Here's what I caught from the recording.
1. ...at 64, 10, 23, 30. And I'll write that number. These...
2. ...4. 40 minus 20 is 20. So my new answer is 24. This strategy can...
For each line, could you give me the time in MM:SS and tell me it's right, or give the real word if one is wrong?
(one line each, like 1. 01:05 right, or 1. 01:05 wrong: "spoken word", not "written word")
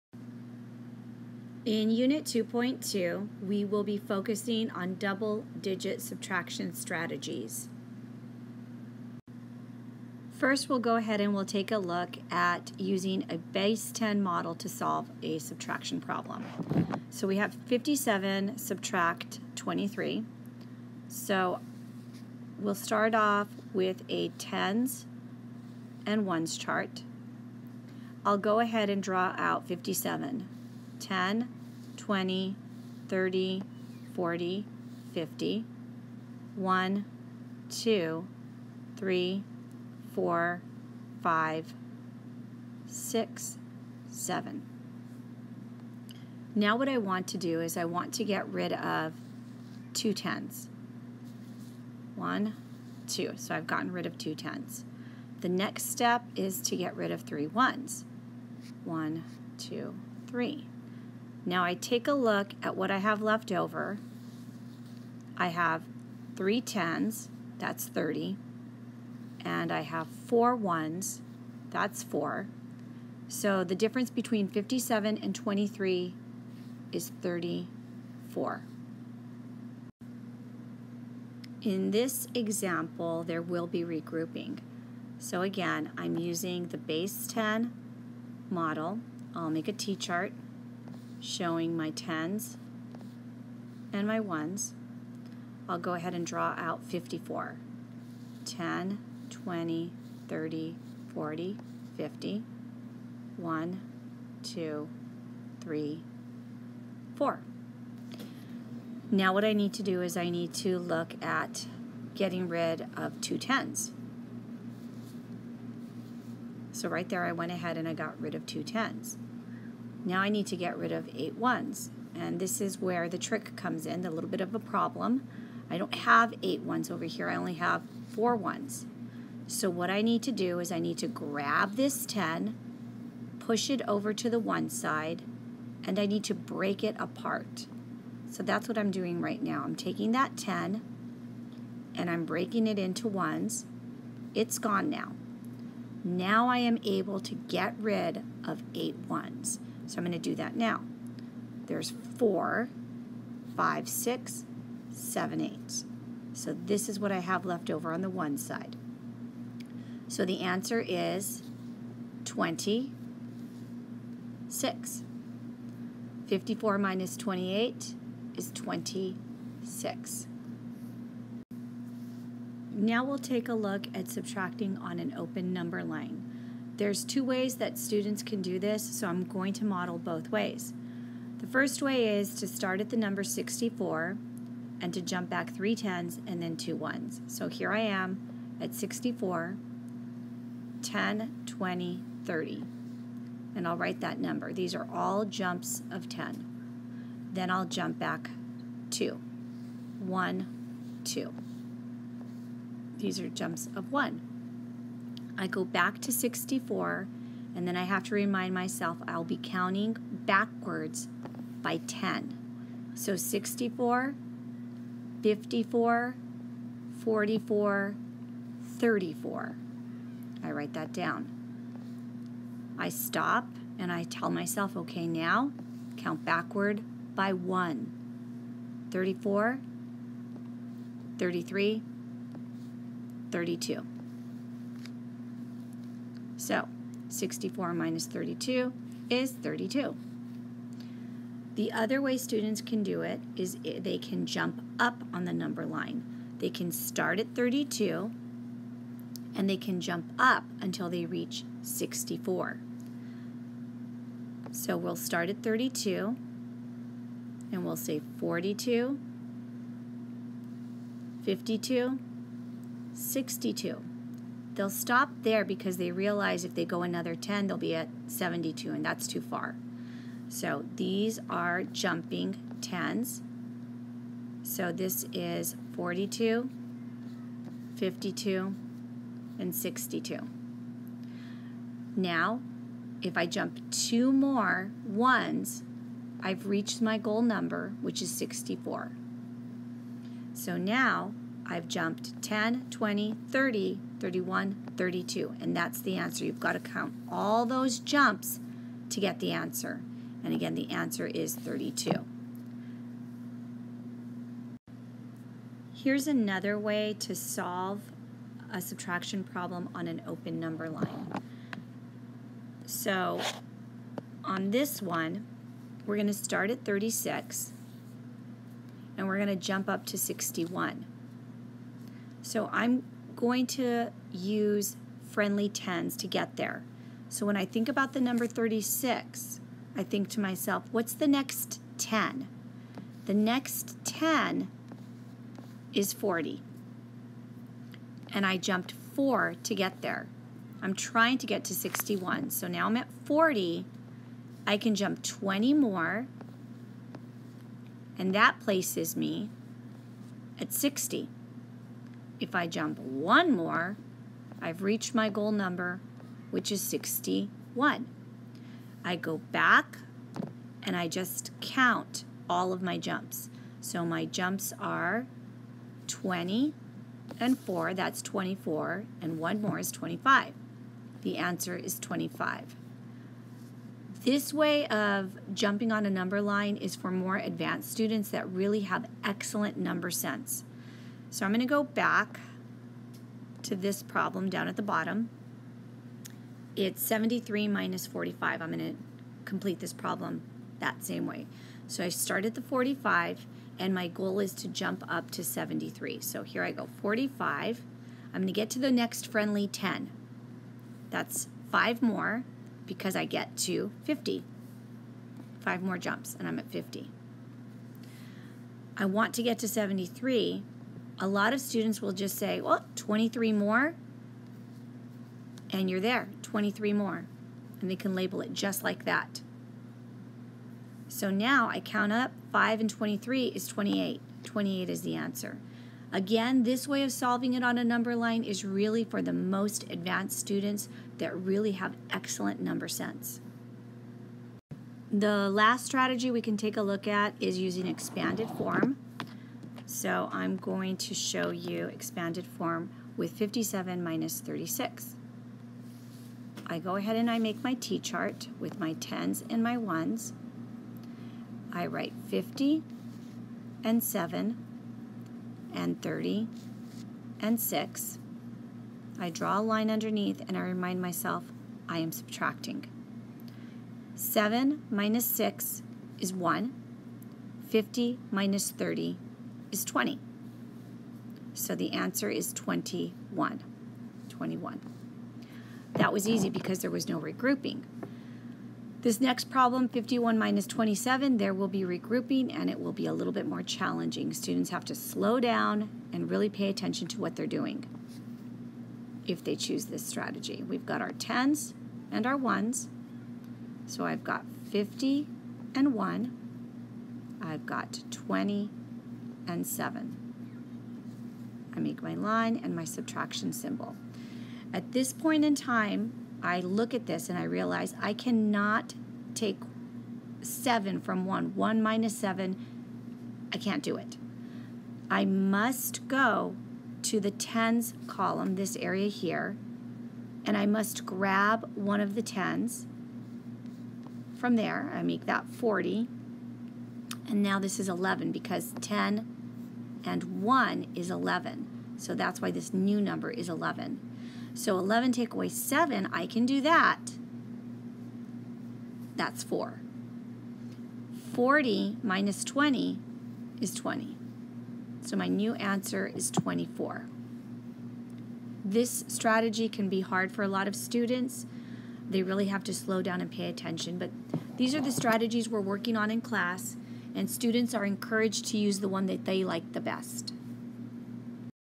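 1. 03:08 wrong: "20", not "23"
2. 08:59 right.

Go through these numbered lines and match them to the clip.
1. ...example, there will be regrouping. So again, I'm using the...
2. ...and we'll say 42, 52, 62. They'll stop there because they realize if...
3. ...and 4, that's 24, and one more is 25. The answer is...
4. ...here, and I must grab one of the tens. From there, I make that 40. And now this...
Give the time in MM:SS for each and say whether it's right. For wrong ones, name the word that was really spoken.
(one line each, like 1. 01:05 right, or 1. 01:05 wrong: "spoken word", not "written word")
1. 01:22 right
2. 04:17 right
3. 06:07 right
4. 08:38 right.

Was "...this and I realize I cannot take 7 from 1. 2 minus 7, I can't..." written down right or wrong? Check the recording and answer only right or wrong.
wrong.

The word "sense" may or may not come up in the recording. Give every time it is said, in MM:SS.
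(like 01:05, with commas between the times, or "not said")
06:19, 07:12.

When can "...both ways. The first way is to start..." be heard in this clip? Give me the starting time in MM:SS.
02:59.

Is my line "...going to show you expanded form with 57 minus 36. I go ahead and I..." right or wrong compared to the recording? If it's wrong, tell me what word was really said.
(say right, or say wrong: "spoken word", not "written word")
right.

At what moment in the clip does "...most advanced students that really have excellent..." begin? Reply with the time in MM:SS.
07:09.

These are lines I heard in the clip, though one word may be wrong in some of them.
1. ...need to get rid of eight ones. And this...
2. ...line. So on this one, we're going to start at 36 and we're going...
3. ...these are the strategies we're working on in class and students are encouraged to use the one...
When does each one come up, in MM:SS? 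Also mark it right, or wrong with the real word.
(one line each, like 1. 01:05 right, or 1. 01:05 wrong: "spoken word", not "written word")
1. 02:00 right
2. 05:10 right
3. 09:14 right.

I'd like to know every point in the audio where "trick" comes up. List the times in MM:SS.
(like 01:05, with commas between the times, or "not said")
02:03.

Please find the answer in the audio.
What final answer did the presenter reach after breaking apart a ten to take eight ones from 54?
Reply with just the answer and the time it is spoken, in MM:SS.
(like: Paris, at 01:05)
26, at 02:40.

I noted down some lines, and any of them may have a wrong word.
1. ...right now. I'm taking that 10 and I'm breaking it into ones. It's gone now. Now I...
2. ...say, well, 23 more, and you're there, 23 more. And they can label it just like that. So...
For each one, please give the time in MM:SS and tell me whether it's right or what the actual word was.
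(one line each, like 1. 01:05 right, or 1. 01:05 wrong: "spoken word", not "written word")
1. 02:19 right
2. 06:52 right.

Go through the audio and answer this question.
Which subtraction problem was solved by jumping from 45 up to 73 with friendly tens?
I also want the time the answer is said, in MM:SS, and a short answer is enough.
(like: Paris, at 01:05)
73 minus 45, at 06:26.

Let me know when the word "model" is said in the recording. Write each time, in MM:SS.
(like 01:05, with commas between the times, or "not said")
00:14, 01:28, 02:59.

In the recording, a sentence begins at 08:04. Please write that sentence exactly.
Students have to slow down and really pay attention to what they're doing if they choose this strategy.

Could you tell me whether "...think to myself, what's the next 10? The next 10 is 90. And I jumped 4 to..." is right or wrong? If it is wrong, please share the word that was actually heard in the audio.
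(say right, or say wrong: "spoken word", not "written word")
wrong: "40", not "90".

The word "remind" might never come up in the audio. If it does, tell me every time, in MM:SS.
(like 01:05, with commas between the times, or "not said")
03:28, 07:40.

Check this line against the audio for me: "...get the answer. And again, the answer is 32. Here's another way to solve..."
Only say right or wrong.
right.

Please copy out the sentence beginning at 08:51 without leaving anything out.
So that's why this new number is 11.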